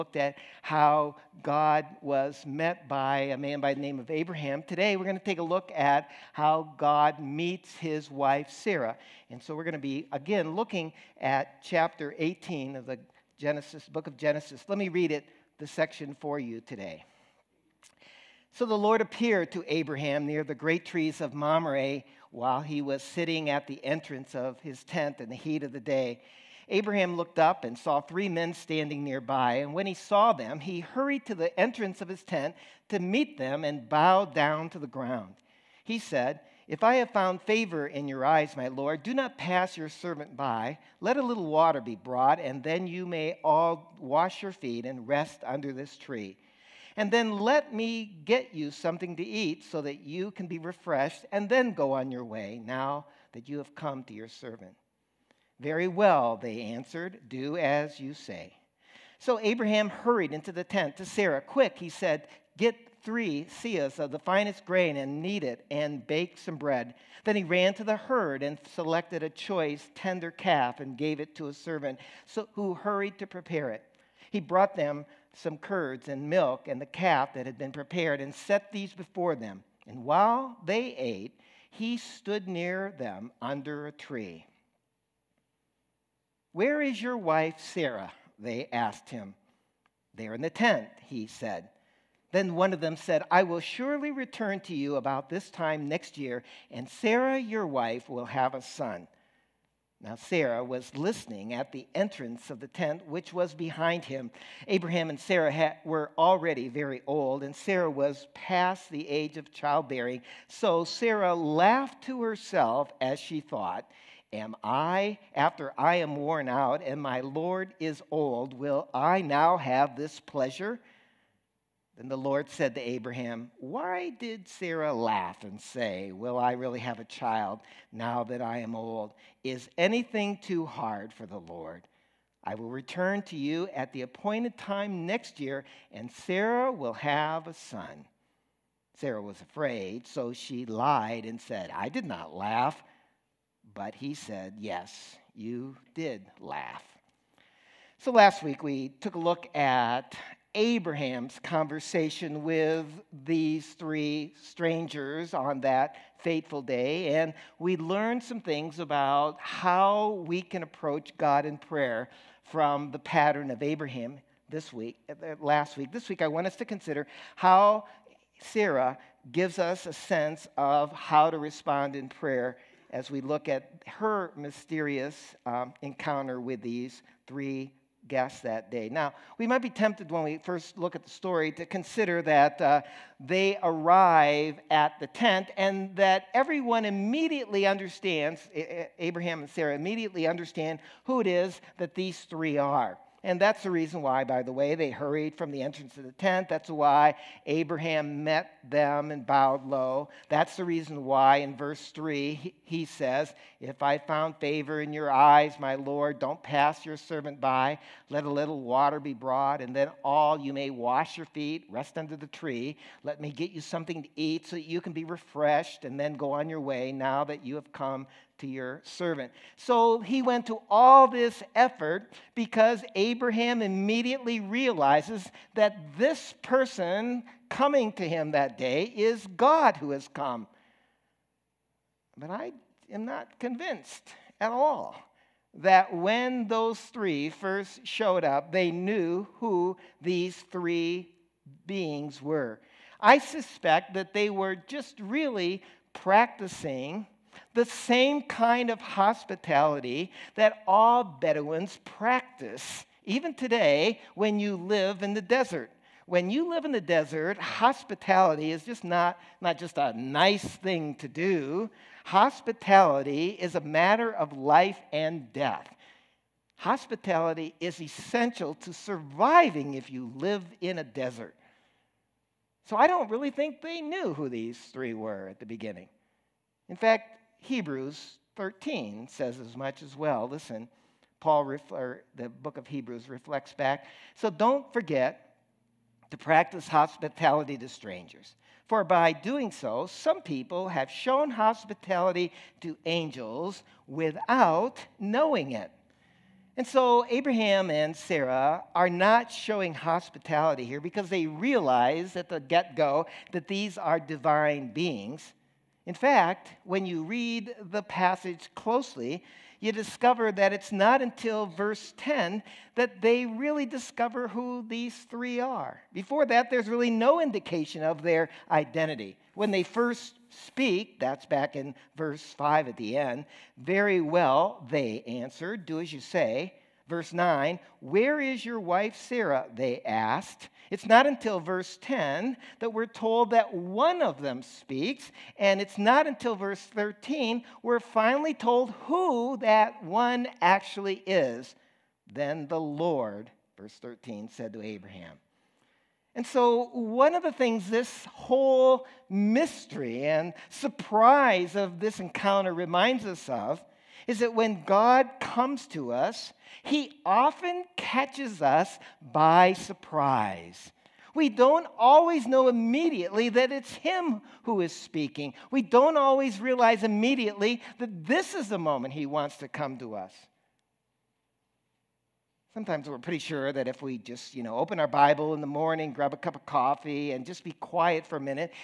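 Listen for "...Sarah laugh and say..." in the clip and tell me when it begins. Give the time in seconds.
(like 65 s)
124 s.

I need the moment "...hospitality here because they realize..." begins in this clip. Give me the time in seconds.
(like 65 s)
299 s.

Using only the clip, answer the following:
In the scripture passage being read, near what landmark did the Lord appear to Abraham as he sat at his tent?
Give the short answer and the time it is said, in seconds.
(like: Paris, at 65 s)
great trees of Mamre, at 20 s.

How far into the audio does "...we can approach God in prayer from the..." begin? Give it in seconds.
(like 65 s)
160 s.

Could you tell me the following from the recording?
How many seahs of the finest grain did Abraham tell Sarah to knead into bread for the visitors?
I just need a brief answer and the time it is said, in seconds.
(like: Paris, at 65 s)
3, at 63 s.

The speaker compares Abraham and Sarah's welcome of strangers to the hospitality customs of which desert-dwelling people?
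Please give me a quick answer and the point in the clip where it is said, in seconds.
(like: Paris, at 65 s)
Bedouins, at 251 s.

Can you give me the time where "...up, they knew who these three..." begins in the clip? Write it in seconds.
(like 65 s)
238 s.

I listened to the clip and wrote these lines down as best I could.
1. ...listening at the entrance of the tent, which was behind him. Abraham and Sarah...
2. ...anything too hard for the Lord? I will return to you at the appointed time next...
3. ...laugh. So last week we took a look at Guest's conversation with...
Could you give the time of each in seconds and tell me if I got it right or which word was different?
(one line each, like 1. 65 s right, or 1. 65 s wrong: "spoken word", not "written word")
1. 100 s right
2. 129 s right
3. 146 s wrong: "Abraham", not "Guest".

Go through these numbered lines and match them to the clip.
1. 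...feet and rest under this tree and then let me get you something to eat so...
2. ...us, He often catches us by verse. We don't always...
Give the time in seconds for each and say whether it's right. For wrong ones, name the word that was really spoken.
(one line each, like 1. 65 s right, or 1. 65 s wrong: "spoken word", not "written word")
1. 44 s right
2. 355 s wrong: "surprise", not "verse".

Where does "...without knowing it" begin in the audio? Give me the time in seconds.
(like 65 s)
293 s.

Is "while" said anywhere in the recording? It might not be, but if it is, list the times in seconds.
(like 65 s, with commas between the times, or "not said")
22 s, 80 s.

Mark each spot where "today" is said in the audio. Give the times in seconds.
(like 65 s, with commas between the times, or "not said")
4 s, 16 s, 253 s.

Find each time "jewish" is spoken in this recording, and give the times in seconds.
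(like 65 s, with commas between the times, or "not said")
not said.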